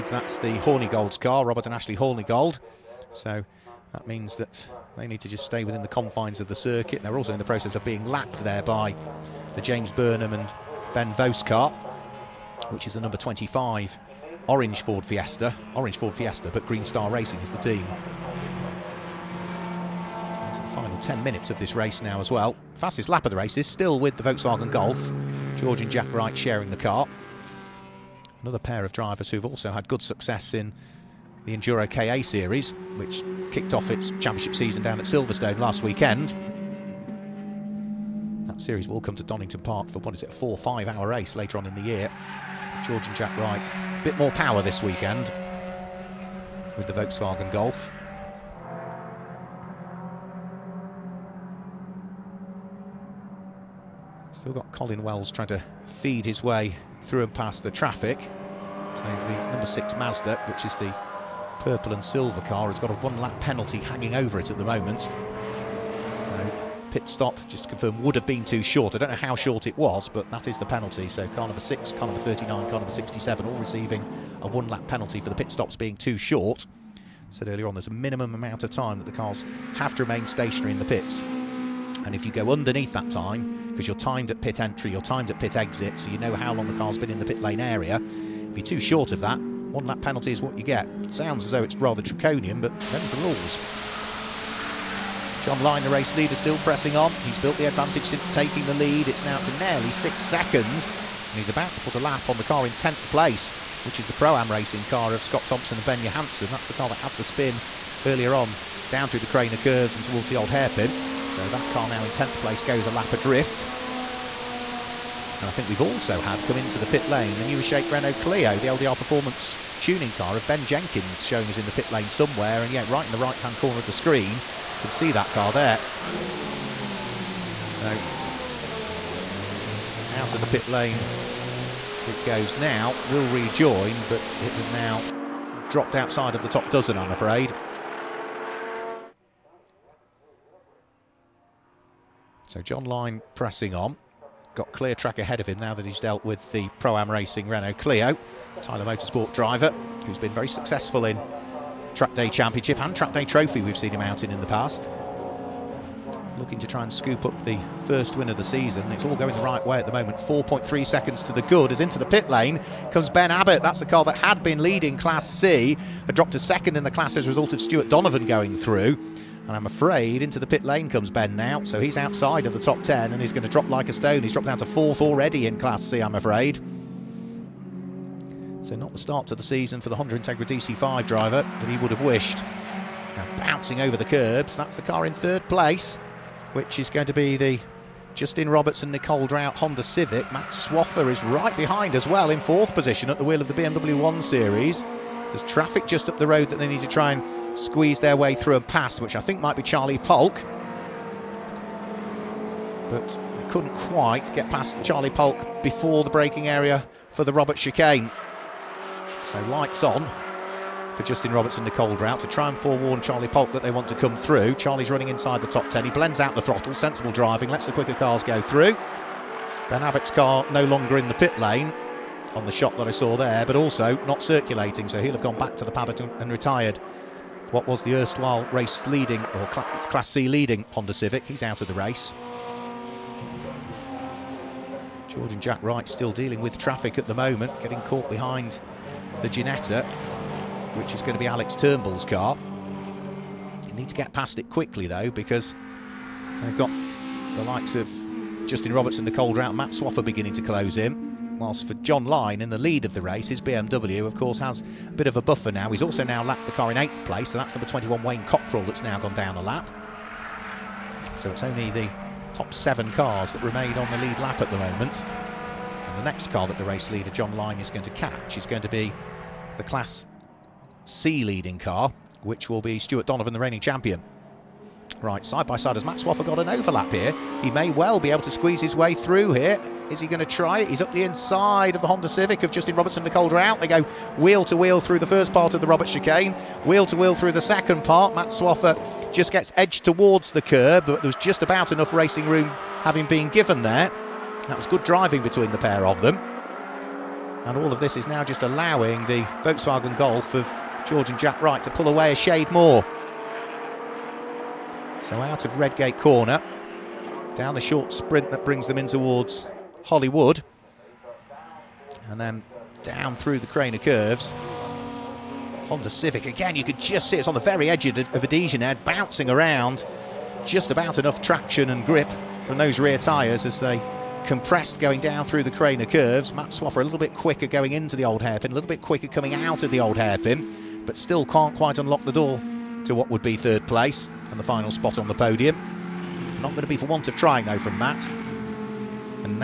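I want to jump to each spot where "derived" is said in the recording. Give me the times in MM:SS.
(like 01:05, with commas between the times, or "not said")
not said.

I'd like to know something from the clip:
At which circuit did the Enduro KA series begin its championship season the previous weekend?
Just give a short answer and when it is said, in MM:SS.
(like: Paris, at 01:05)
Silverstone, at 00:35.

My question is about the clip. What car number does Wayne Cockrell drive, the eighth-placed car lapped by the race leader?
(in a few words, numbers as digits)
21.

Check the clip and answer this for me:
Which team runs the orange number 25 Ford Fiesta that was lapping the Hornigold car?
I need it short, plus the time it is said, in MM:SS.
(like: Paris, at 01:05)
Green Star Racing, at 00:16.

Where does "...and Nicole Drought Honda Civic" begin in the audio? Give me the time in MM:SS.
03:08.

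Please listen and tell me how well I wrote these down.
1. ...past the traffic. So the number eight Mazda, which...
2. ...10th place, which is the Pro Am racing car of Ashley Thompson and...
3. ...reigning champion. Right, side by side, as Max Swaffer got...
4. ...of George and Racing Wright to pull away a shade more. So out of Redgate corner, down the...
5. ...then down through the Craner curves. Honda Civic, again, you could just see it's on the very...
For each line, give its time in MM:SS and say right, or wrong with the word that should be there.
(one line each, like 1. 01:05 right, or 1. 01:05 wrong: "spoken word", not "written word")
1. 00:57 wrong: "six", not "eight"
2. 01:42 wrong: "Scott", not "Ashley"
3. 04:33 right
4. 05:00 wrong: "Jack", not "Racing"
5. 05:12 right.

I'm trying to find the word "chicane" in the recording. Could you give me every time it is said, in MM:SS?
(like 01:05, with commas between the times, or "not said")
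03:27, 04:45.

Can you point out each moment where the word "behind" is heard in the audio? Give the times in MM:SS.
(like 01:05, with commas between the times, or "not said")
03:11, 03:58.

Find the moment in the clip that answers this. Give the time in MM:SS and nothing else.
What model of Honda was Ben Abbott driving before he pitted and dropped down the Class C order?
03:00.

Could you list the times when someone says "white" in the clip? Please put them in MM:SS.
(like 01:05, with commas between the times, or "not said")
not said.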